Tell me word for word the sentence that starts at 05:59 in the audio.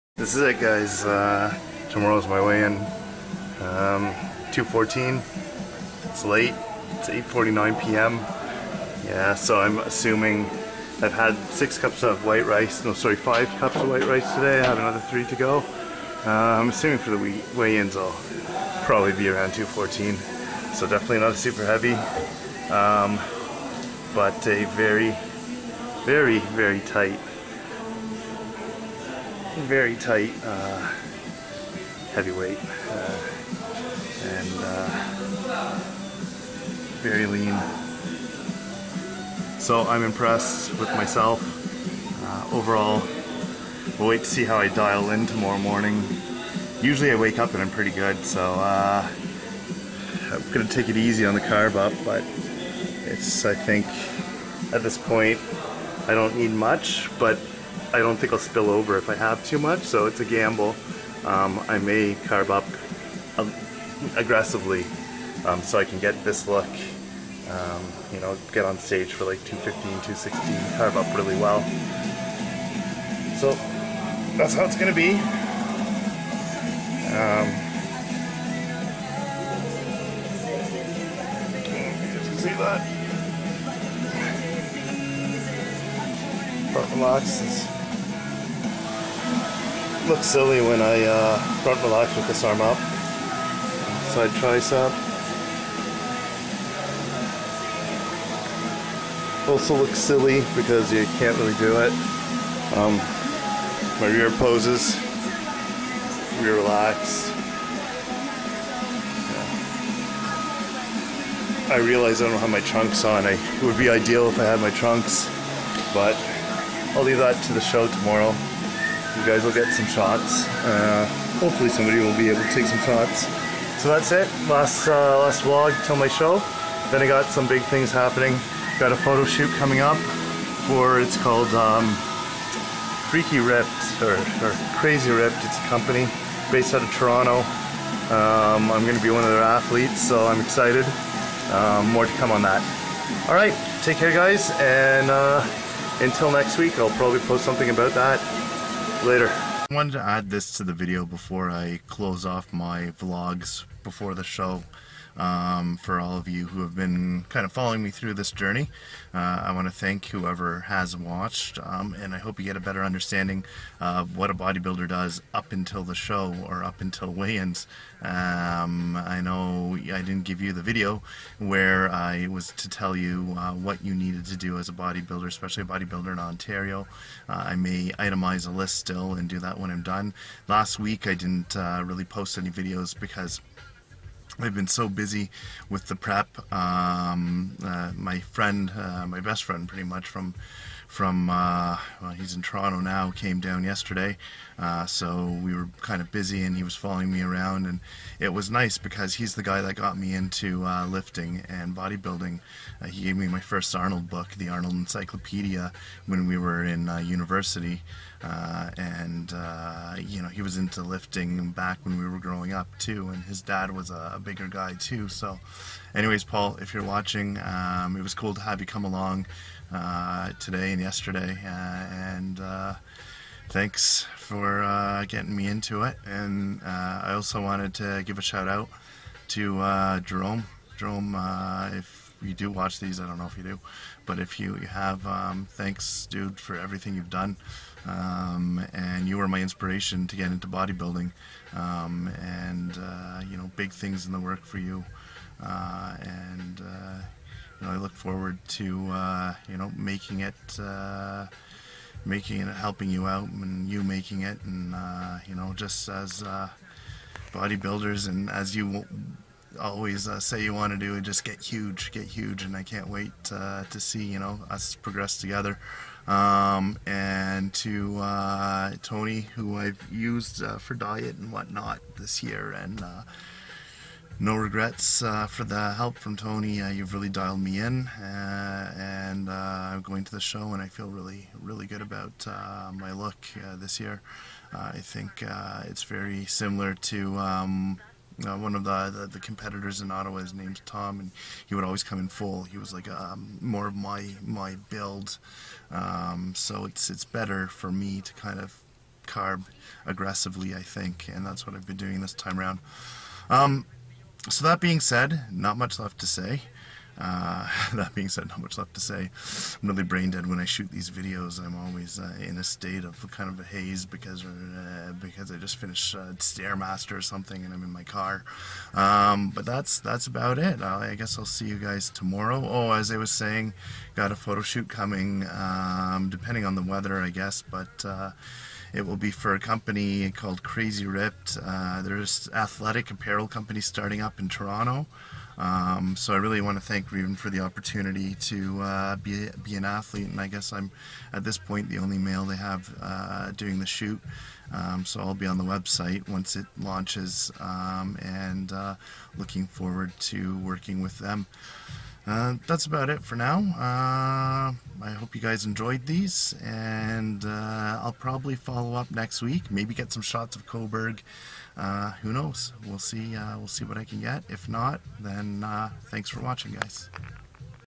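Maybe get some shots of Cobourg.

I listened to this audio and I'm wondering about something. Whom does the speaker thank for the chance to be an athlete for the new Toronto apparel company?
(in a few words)
Reuben.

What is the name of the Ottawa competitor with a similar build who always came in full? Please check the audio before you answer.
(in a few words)
Tom.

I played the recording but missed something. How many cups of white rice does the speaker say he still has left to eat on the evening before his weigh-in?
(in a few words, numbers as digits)
3.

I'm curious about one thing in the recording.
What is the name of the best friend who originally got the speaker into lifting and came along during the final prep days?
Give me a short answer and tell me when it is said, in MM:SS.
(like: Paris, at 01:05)
Paul, at 03:36.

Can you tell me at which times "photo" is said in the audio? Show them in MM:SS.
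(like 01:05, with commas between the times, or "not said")
02:08, 05:24.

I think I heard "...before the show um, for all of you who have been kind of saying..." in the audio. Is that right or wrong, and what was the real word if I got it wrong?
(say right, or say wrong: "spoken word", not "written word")
wrong: "following", not "saying".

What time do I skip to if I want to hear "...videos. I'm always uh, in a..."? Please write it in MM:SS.
05:10.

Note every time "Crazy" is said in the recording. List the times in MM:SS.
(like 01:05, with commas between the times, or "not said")
02:14, 05:30.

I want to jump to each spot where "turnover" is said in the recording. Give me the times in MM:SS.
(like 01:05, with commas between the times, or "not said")
not said.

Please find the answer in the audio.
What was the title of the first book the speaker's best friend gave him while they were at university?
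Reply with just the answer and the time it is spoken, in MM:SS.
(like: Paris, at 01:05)
Arnold Encyclopedia, at 03:24.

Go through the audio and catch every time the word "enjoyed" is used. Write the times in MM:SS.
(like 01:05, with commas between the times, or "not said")
05:55.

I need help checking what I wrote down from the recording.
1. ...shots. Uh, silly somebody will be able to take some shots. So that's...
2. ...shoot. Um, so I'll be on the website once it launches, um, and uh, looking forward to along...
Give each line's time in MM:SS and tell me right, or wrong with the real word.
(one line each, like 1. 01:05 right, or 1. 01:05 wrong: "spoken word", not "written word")
1. 01:59 wrong: "hopefully", not "silly"
2. 05:43 wrong: "working", not "along".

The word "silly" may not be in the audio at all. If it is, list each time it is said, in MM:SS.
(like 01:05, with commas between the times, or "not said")
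01:30, 01:39.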